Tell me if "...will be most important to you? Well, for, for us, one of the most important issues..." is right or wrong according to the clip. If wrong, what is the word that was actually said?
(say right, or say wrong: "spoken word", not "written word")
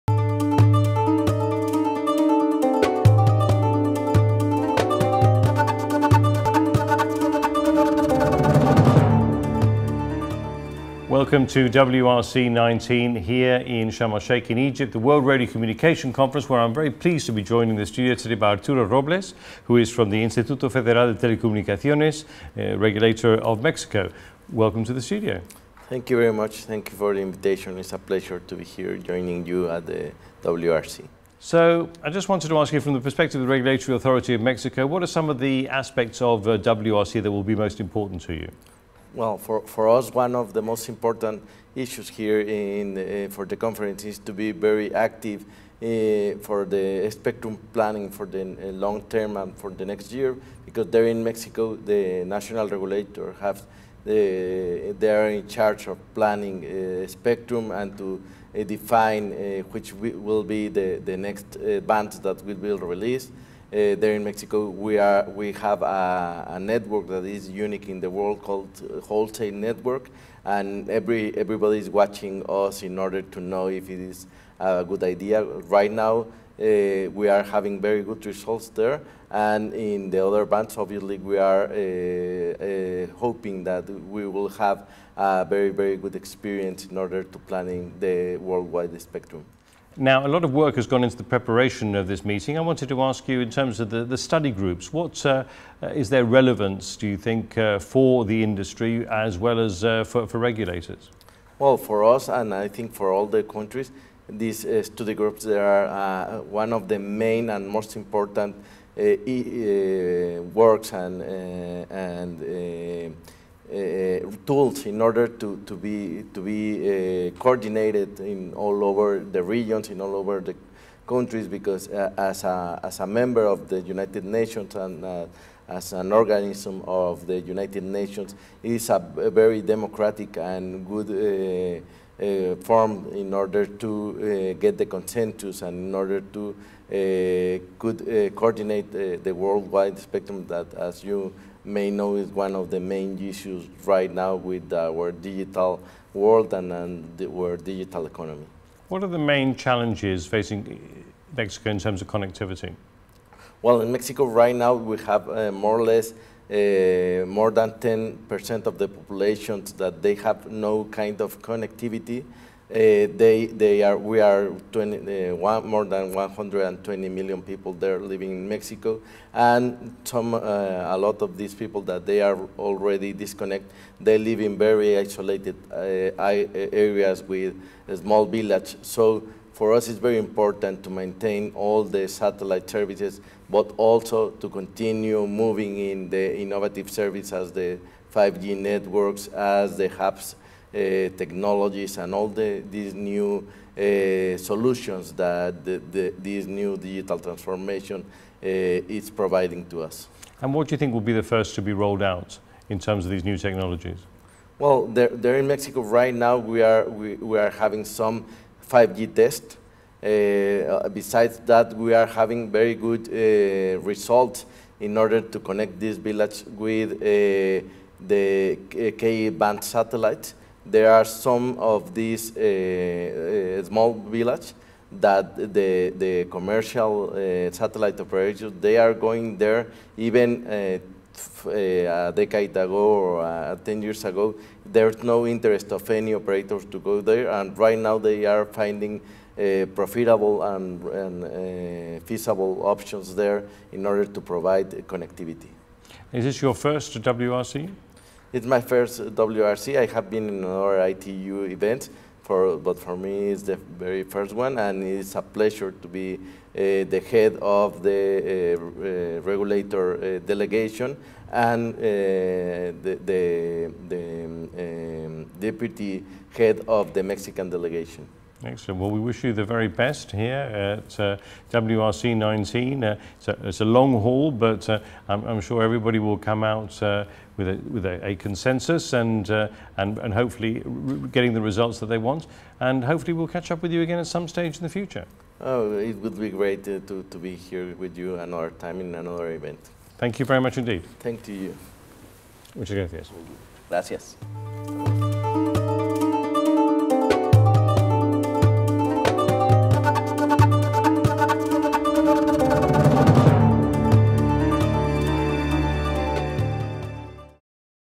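right.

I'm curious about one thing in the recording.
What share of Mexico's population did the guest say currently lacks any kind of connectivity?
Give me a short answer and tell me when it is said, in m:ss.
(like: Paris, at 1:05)
more than 10%, at 2:37.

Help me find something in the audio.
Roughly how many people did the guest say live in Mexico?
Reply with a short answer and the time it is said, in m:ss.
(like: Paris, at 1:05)
more than 120 million, at 2:45.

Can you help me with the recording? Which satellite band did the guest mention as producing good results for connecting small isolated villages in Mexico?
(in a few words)
K-band.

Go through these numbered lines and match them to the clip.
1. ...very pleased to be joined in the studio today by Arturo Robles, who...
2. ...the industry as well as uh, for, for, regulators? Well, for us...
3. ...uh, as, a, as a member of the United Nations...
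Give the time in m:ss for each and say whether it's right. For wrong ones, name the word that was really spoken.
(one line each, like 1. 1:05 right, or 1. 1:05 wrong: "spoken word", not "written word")
1. 0:16 right
2. 1:38 right
3. 2:01 right.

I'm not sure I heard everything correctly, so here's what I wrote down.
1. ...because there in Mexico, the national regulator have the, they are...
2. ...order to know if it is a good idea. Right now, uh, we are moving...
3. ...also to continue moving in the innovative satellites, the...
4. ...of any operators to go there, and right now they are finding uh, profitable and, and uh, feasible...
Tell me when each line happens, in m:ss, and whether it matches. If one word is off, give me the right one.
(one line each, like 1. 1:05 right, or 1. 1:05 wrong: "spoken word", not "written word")
1. 0:50 right
2. 1:12 wrong: "having", not "moving"
3. 3:03 wrong: "services", not "satellites"
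4. 3:55 right.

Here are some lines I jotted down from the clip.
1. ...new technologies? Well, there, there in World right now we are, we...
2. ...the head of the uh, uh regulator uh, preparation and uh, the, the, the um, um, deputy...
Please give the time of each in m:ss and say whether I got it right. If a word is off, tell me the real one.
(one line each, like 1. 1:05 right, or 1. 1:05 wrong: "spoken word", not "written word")
1. 3:23 wrong: "Mexico", not "World"
2. 4:16 wrong: "delegation", not "preparation".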